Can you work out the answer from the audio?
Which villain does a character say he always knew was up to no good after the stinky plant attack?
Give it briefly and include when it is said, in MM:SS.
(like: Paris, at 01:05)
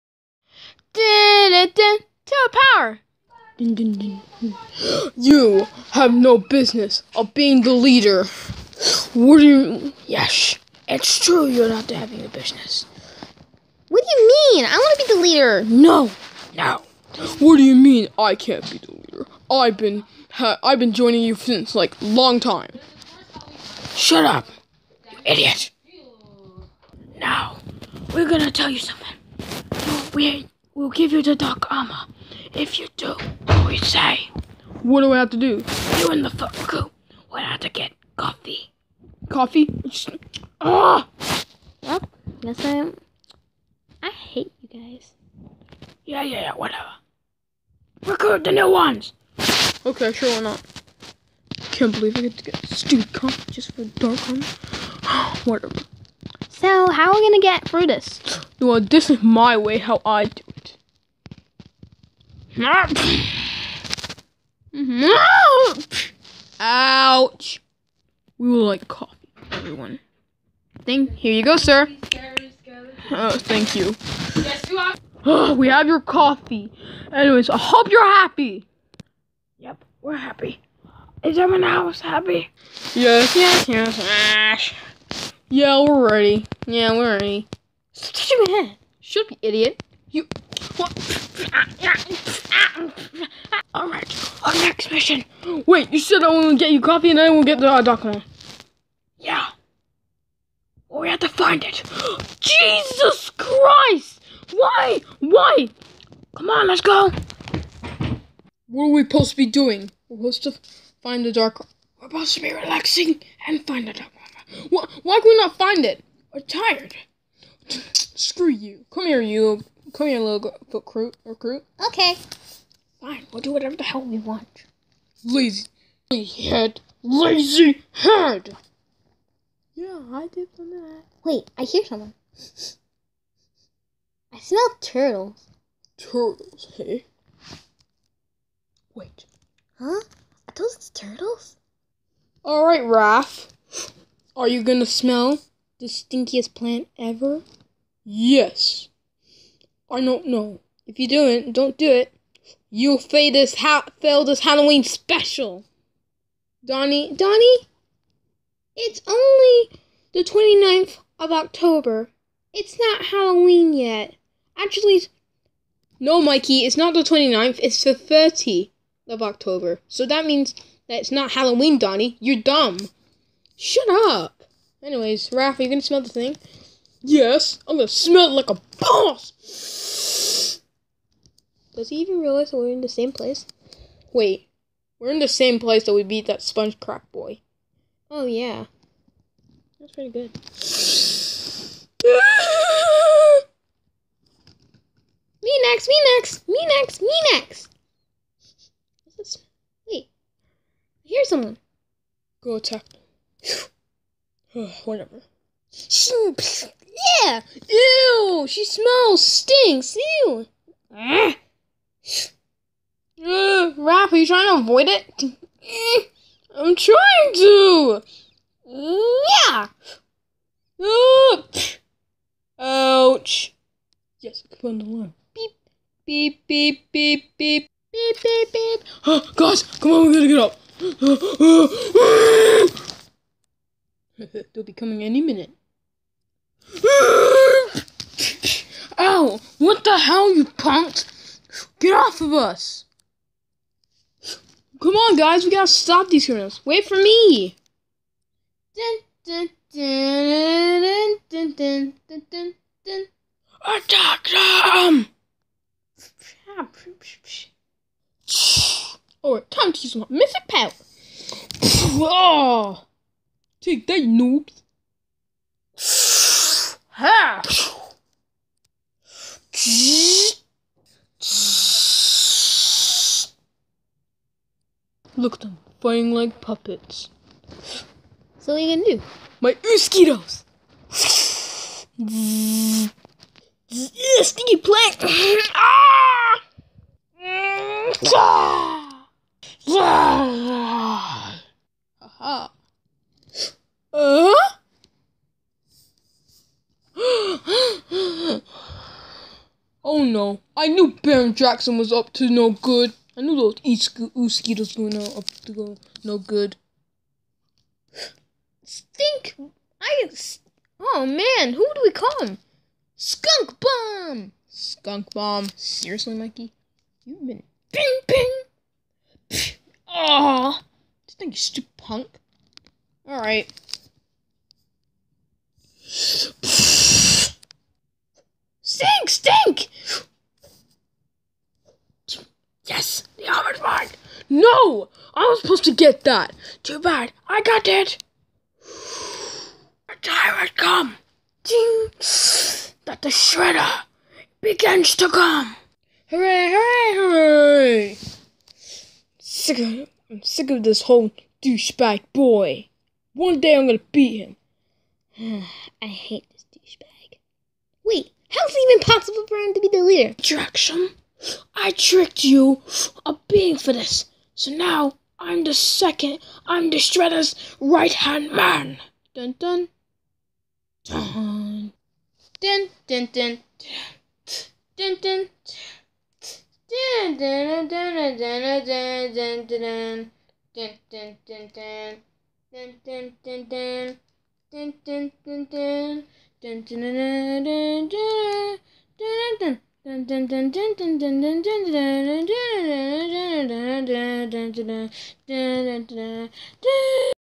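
Baron Draxum, at 05:01.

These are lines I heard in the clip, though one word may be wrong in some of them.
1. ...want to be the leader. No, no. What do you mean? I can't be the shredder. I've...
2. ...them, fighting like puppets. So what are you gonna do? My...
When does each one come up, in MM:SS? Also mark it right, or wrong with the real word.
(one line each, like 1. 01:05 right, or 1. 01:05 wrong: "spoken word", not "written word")
1. 00:14 wrong: "leader", not "shredder"
2. 04:35 right.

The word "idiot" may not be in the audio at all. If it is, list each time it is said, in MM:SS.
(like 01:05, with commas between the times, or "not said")
00:25, 01:29.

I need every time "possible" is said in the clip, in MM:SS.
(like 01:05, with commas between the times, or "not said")
05:58.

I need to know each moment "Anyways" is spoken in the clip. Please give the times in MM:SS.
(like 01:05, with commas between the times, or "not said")
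01:17, 02:54.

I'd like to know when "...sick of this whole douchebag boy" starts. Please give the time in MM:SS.
05:50.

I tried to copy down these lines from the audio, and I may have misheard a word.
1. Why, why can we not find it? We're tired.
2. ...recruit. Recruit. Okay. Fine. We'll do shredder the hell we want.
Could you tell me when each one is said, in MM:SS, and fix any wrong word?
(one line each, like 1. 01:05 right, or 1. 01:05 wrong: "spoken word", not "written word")
1. 01:54 right
2. 02:00 wrong: "whatever", not "shredder".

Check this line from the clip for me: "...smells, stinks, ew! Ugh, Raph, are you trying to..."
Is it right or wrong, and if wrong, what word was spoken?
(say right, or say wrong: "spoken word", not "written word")
right.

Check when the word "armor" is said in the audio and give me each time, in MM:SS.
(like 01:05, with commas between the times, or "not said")
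00:31, 00:54.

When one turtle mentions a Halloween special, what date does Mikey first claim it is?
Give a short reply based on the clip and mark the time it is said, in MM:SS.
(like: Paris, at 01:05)
29th of October, at 02:40.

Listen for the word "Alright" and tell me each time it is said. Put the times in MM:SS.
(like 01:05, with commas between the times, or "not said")
01:33, 02:22, 04:19, 05:23.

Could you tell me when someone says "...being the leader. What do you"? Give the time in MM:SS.
00:07.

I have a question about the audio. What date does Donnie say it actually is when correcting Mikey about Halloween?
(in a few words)
30th of October.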